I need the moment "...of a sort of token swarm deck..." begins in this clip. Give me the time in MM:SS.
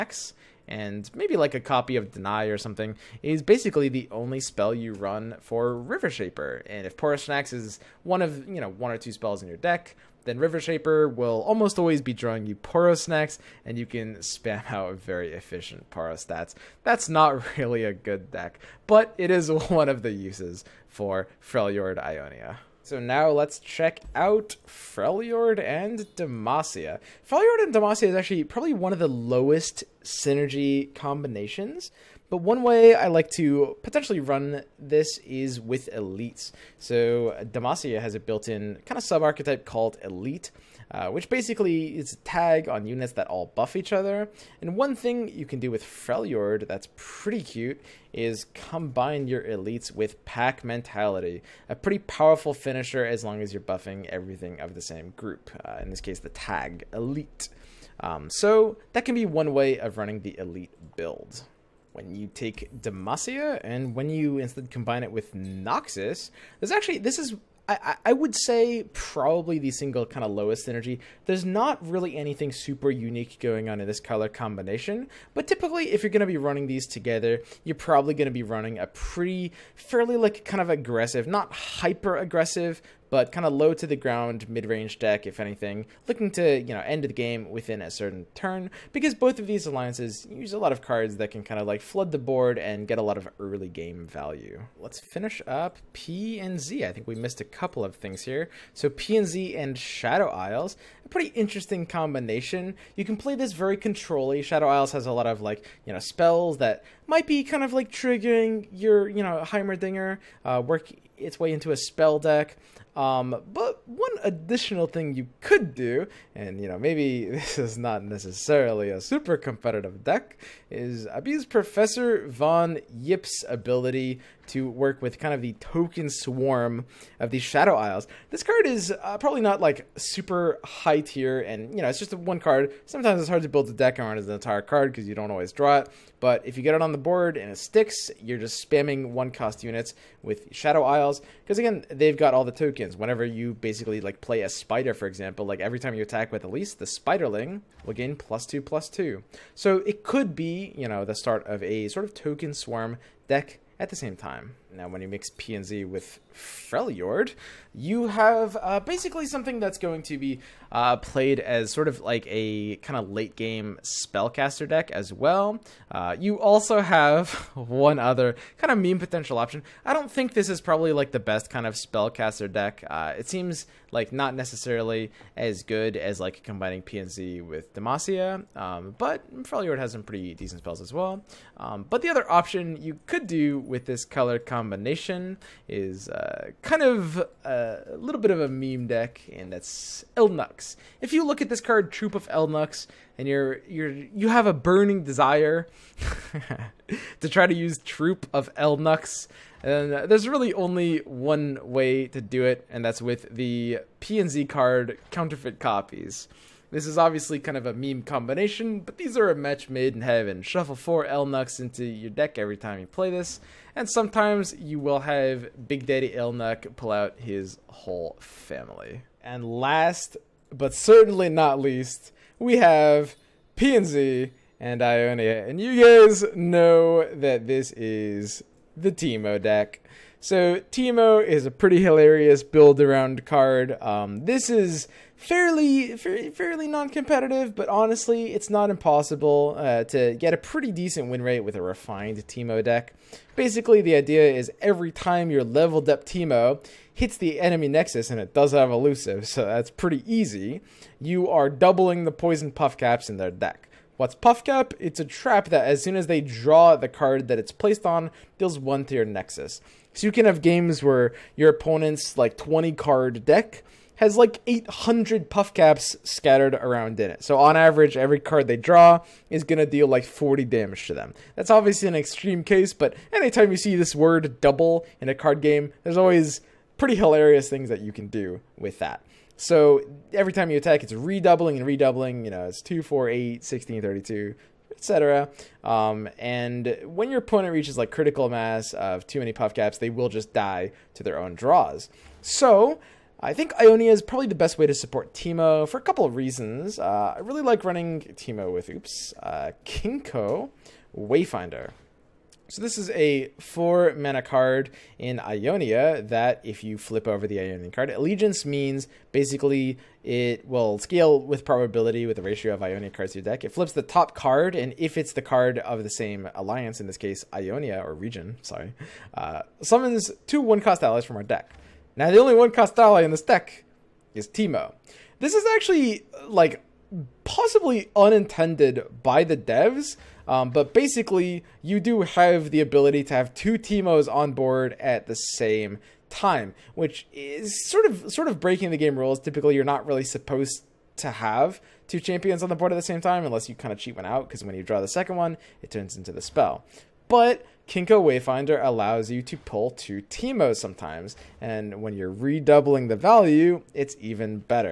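02:31.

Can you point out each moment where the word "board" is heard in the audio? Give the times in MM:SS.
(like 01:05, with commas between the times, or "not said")
01:32, 02:16, 05:34, 05:42.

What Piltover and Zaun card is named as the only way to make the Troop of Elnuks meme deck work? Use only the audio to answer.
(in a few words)
Counterfeit Copies.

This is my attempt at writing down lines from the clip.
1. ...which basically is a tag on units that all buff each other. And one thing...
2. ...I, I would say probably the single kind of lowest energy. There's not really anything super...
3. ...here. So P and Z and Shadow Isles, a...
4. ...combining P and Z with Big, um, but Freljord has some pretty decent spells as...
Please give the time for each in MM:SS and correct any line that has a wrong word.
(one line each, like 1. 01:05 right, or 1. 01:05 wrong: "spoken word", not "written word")
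1. 00:41 right
2. 01:07 right
3. 01:38 right
4. 02:56 wrong: "Demacia", not "Big".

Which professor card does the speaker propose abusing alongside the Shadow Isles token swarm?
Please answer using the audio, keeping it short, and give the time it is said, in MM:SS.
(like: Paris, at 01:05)
Professor Von Yipp, at 02:01.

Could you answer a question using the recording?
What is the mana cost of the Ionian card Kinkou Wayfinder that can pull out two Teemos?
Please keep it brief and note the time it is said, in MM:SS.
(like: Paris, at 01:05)
4, at 05:03.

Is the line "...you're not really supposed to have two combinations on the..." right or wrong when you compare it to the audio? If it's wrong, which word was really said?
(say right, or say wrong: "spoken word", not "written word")
wrong: "champions", not "combinations".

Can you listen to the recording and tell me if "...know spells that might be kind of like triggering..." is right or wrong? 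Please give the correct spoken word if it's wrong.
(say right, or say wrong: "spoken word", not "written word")
right.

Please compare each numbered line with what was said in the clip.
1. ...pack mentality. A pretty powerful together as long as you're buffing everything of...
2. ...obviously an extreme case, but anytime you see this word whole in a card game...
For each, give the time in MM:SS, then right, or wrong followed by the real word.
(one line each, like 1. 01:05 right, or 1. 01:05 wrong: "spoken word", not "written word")
1. 00:50 wrong: "finisher", not "together"
2. 04:31 wrong: "double", not "whole".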